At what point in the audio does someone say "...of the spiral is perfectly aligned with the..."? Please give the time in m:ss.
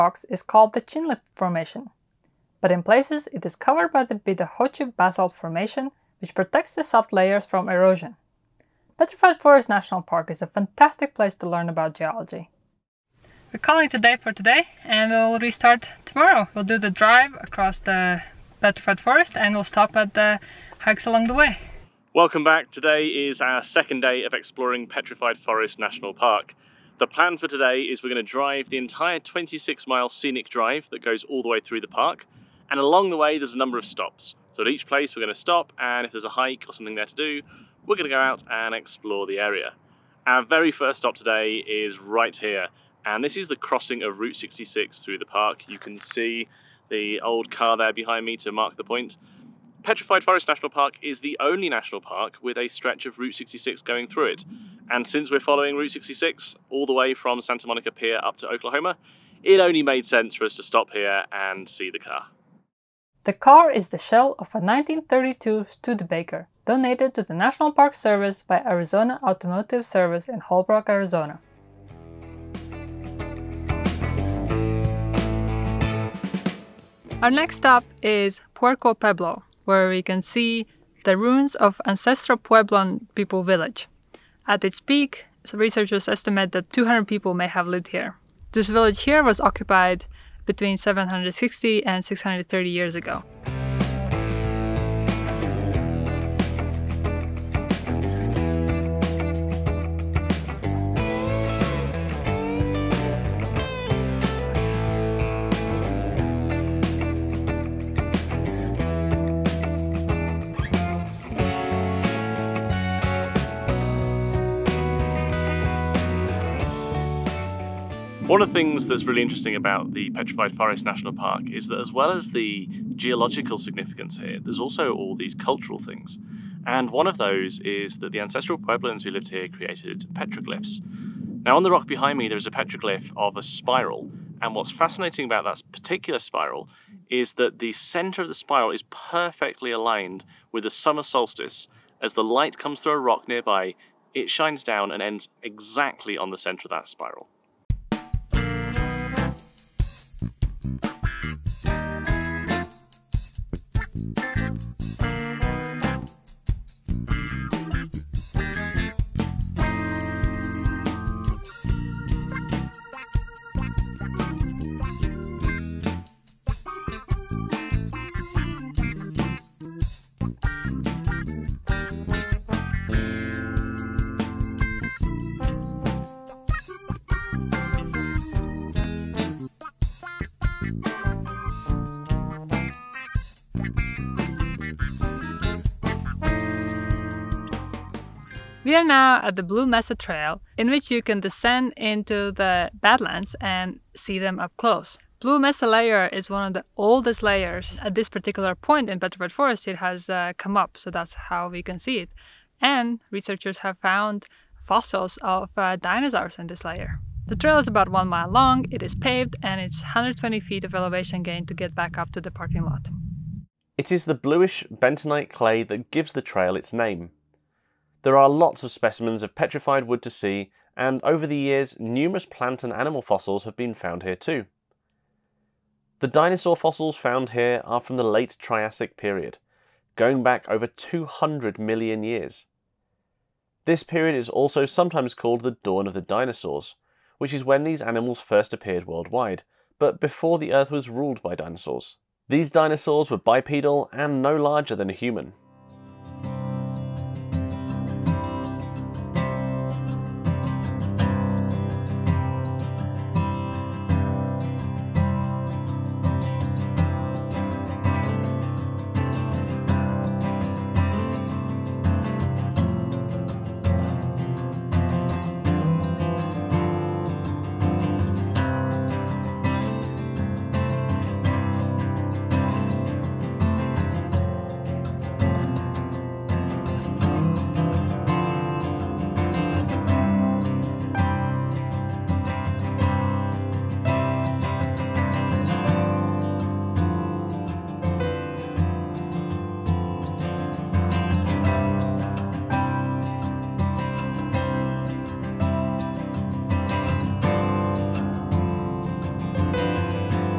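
2:18.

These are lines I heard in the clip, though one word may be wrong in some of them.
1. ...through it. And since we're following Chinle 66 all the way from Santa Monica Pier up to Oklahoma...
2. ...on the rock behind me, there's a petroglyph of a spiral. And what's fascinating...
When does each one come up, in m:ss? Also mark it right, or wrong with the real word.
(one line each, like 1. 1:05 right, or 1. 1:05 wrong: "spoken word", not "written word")
1. 0:54 wrong: "Route", not "Chinle"
2. 2:11 right.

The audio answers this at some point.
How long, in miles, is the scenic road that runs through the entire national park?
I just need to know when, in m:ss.
0:29.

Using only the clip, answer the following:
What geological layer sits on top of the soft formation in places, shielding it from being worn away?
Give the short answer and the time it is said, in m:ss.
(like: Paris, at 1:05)
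Bidahochi Basalt Formation, at 0:04.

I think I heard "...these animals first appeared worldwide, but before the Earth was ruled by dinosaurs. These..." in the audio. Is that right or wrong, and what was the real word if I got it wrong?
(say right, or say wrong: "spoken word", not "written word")
right.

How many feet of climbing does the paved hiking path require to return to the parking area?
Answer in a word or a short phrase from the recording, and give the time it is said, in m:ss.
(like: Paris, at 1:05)
120, at 3:29.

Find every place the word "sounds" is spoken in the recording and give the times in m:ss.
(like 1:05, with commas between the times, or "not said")
not said.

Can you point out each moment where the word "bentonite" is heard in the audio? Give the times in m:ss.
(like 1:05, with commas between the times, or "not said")
3:34.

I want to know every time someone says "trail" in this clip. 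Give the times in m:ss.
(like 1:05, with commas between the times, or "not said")
3:09, 3:27, 3:36.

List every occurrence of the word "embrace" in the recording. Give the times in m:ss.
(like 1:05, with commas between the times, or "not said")
not said.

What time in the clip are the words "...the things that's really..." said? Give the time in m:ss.
1:58.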